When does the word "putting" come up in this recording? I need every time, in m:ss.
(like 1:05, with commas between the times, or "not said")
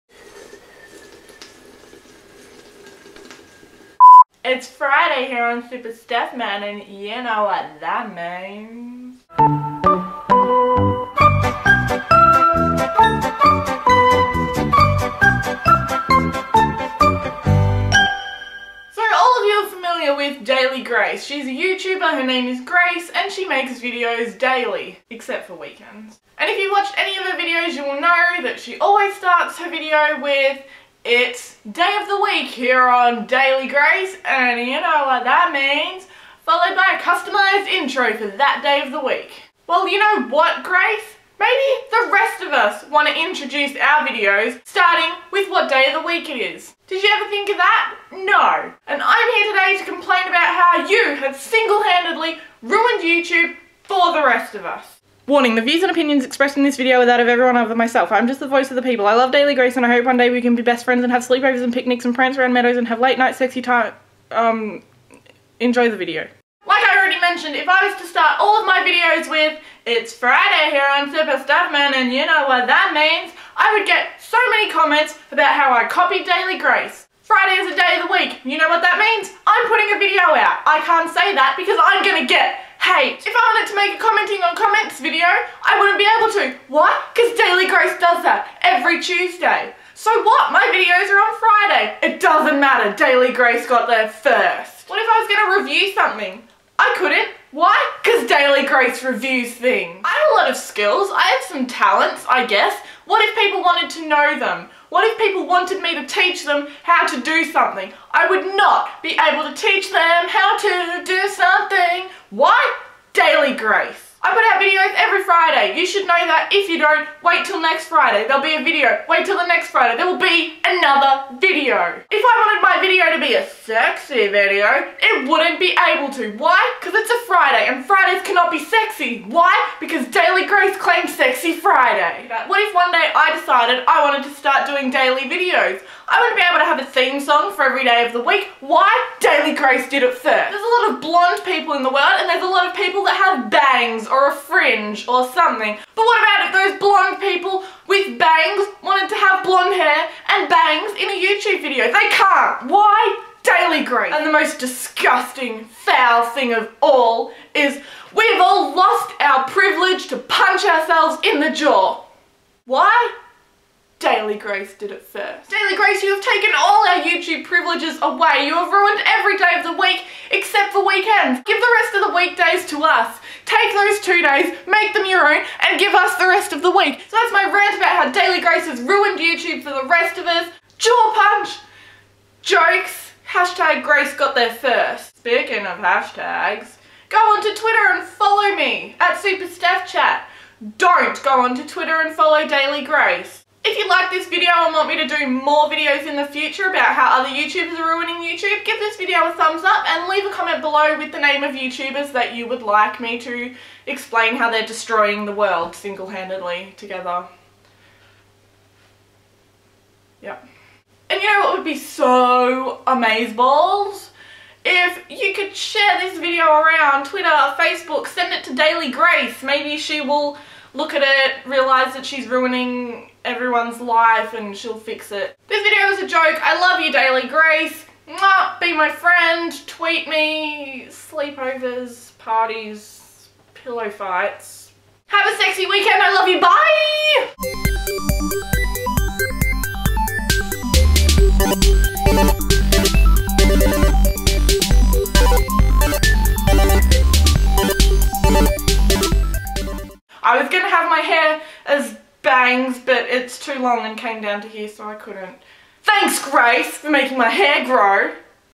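1:19.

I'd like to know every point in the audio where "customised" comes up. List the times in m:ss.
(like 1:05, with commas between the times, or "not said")
0:37.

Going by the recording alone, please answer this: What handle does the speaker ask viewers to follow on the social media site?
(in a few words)
Super Steph Chat.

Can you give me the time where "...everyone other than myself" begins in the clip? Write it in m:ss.
0:57.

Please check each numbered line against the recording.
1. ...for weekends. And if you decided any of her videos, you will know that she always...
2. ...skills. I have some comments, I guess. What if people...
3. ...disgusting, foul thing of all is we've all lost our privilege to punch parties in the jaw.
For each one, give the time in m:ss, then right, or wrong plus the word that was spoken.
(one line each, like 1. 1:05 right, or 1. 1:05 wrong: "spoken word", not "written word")
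1. 0:25 wrong: "watched", not "decided"
2. 1:40 wrong: "talents", not "comments"
3. 2:34 wrong: "ourselves", not "parties".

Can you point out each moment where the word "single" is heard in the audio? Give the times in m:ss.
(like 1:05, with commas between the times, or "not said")
0:51, 3:25.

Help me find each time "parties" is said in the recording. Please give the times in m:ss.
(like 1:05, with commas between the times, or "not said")
3:52.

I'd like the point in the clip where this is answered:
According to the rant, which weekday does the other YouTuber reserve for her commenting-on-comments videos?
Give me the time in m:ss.
1:29.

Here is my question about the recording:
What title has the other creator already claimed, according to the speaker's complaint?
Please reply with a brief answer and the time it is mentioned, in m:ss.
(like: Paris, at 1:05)
Sexy Friday, at 2:11.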